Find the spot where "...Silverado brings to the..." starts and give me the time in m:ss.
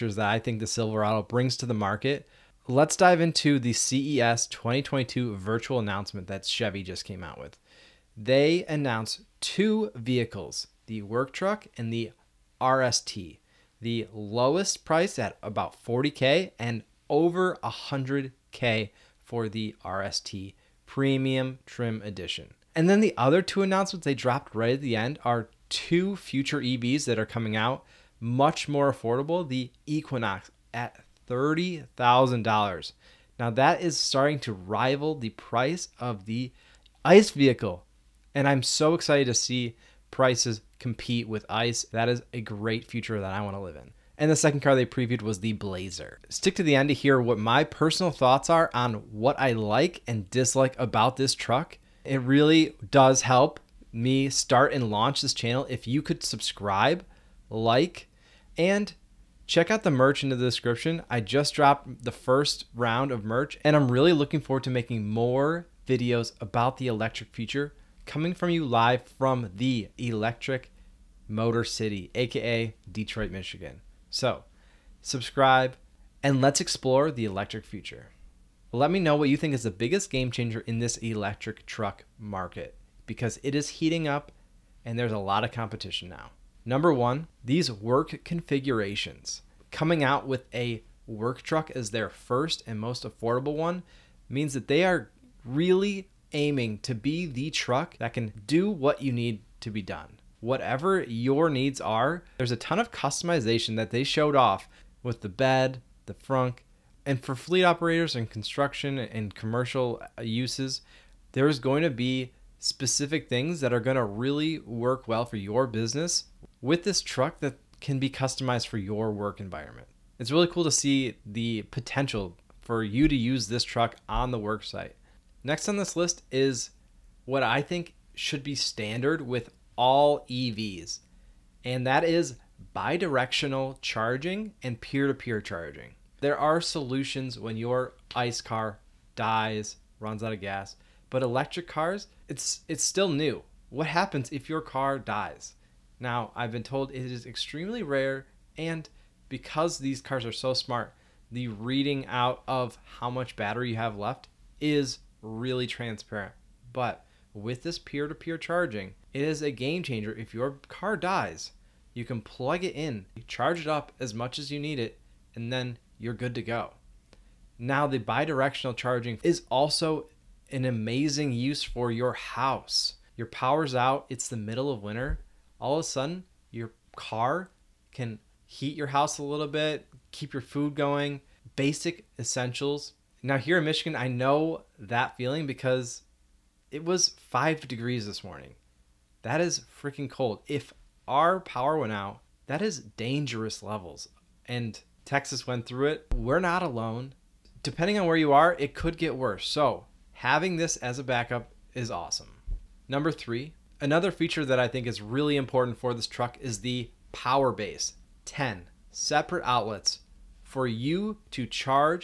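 0:00.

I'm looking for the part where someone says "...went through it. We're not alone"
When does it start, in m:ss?
3:15.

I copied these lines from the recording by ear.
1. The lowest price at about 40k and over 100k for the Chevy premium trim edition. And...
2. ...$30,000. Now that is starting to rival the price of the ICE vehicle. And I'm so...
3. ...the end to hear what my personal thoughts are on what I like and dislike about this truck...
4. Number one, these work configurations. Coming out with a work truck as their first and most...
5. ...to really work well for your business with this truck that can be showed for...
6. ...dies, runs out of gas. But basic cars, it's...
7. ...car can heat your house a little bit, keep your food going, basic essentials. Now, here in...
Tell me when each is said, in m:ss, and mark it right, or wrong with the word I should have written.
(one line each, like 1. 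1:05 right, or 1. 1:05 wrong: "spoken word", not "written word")
1. 0:13 wrong: "RST", not "Chevy"
2. 0:31 right
3. 0:46 right
4. 1:26 right
5. 1:53 wrong: "customized", not "showed"
6. 2:19 wrong: "electric", not "basic"
7. 2:56 right.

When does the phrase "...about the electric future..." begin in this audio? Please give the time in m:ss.
1:06.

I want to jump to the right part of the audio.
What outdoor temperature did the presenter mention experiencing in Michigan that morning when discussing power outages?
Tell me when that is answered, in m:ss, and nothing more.
3:07.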